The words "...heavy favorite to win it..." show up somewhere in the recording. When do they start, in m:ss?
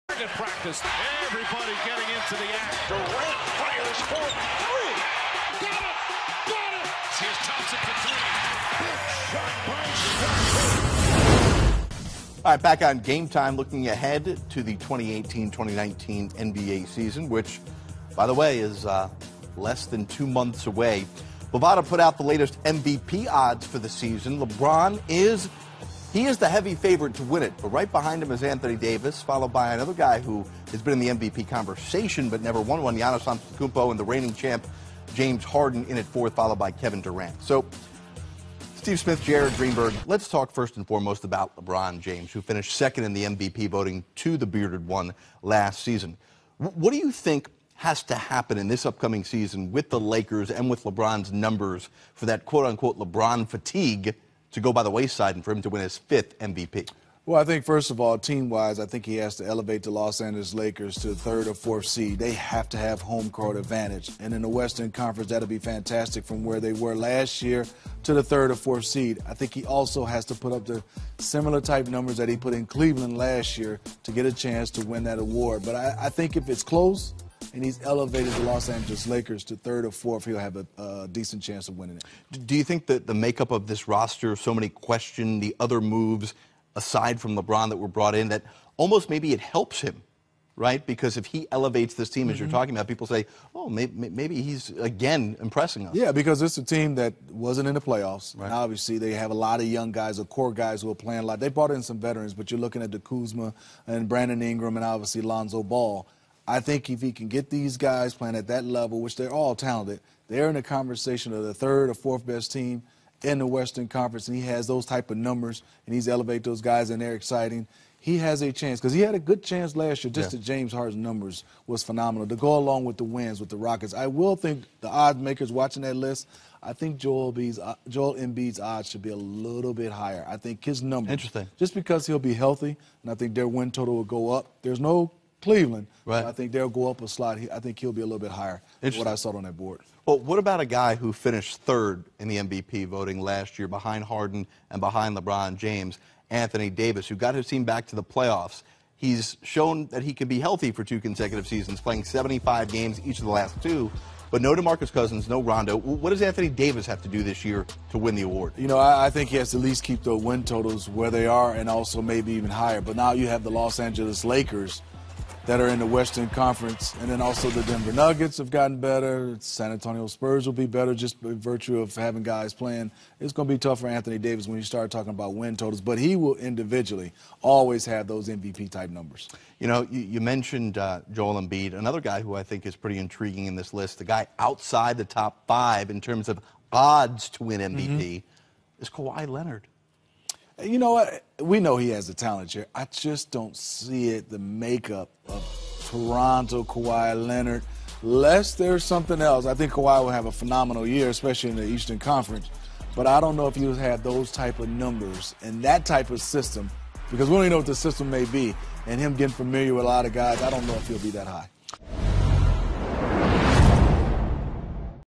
0:26.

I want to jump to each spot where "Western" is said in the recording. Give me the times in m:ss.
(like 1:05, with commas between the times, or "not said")
1:04, 1:53, 2:45.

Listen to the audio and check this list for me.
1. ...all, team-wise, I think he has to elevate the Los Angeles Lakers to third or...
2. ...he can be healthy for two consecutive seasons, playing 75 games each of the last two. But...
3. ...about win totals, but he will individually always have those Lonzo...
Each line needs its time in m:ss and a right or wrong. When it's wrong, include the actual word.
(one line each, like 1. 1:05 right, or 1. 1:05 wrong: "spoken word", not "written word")
1. 0:58 right
2. 2:30 right
3. 2:55 wrong: "MVP", not "Lonzo".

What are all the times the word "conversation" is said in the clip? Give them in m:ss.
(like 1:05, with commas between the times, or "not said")
0:31, 1:50.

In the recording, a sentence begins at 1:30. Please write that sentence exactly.
Because if he elevates this team, as you're mm-hmm.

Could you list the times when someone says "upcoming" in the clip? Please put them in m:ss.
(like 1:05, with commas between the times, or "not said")
0:48.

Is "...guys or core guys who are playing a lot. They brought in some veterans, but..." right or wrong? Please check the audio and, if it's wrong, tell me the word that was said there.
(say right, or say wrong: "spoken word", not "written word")
right.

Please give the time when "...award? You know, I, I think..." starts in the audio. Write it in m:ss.
2:38.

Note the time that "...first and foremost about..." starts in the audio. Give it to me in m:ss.
0:40.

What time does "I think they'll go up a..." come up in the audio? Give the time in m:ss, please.
2:16.